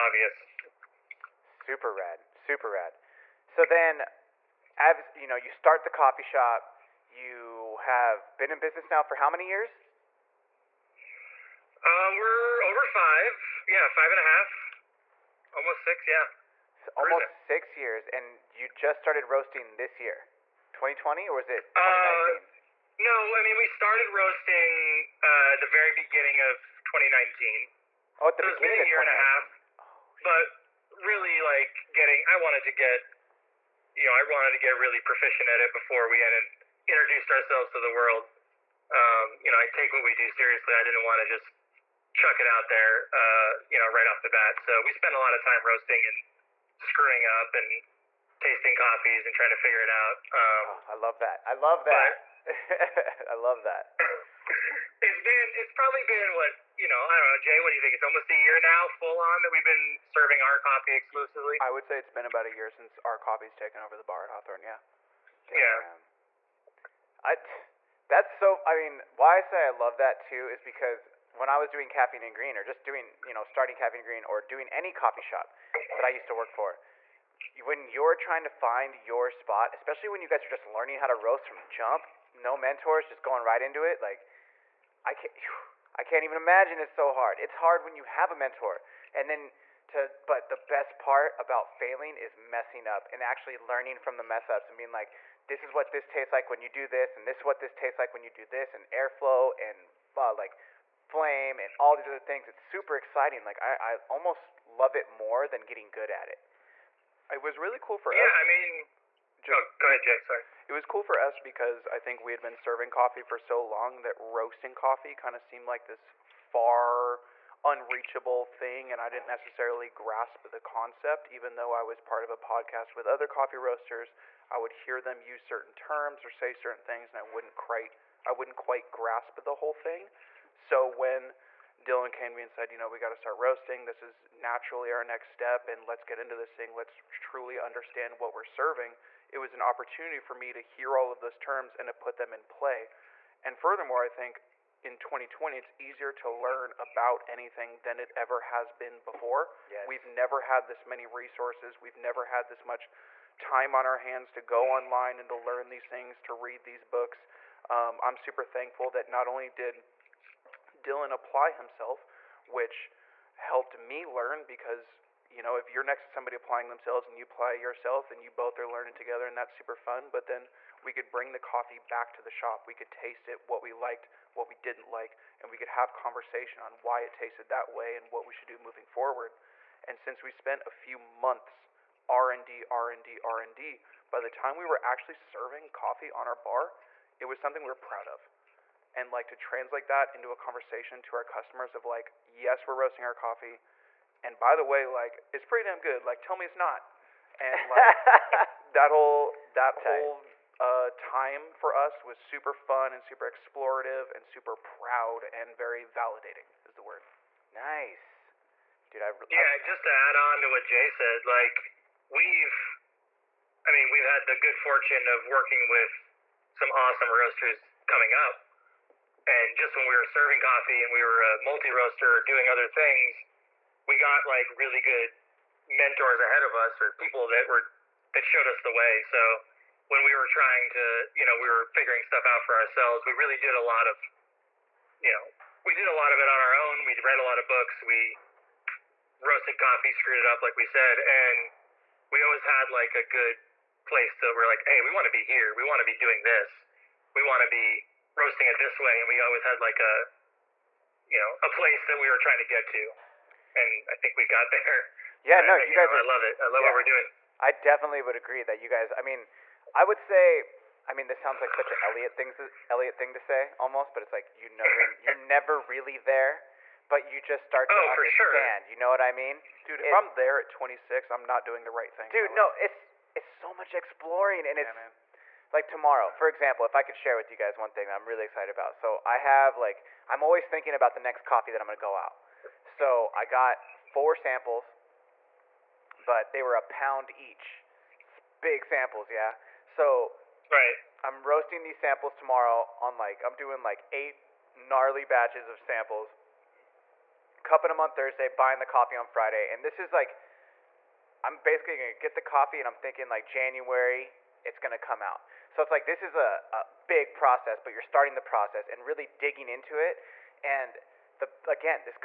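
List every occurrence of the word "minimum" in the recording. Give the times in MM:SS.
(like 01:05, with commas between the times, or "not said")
not said.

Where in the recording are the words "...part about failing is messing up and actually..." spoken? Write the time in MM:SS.
01:30.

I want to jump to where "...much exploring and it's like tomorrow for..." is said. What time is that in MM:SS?
04:33.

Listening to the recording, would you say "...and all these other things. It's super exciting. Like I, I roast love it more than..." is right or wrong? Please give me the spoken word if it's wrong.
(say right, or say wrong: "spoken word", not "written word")
wrong: "almost", not "roast".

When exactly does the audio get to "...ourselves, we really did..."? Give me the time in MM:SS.
03:52.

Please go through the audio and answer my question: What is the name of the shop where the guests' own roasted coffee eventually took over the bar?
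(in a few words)
Hawthorn.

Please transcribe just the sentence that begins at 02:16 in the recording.
Let's truly understand what we're serving.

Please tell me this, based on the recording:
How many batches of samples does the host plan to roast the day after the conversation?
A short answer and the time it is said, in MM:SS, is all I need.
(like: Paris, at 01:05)
8, at 04:53.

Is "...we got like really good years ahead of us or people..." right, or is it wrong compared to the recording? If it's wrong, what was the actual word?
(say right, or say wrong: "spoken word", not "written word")
wrong: "mentors", not "years".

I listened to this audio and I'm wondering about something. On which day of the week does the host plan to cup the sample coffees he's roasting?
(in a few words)
Thursday.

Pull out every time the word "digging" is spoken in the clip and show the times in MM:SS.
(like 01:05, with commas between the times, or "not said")
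05:09.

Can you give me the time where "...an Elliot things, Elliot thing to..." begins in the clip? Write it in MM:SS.
04:21.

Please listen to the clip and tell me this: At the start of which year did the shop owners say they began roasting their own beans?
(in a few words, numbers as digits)
2019.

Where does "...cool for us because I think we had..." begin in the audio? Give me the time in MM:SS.
01:50.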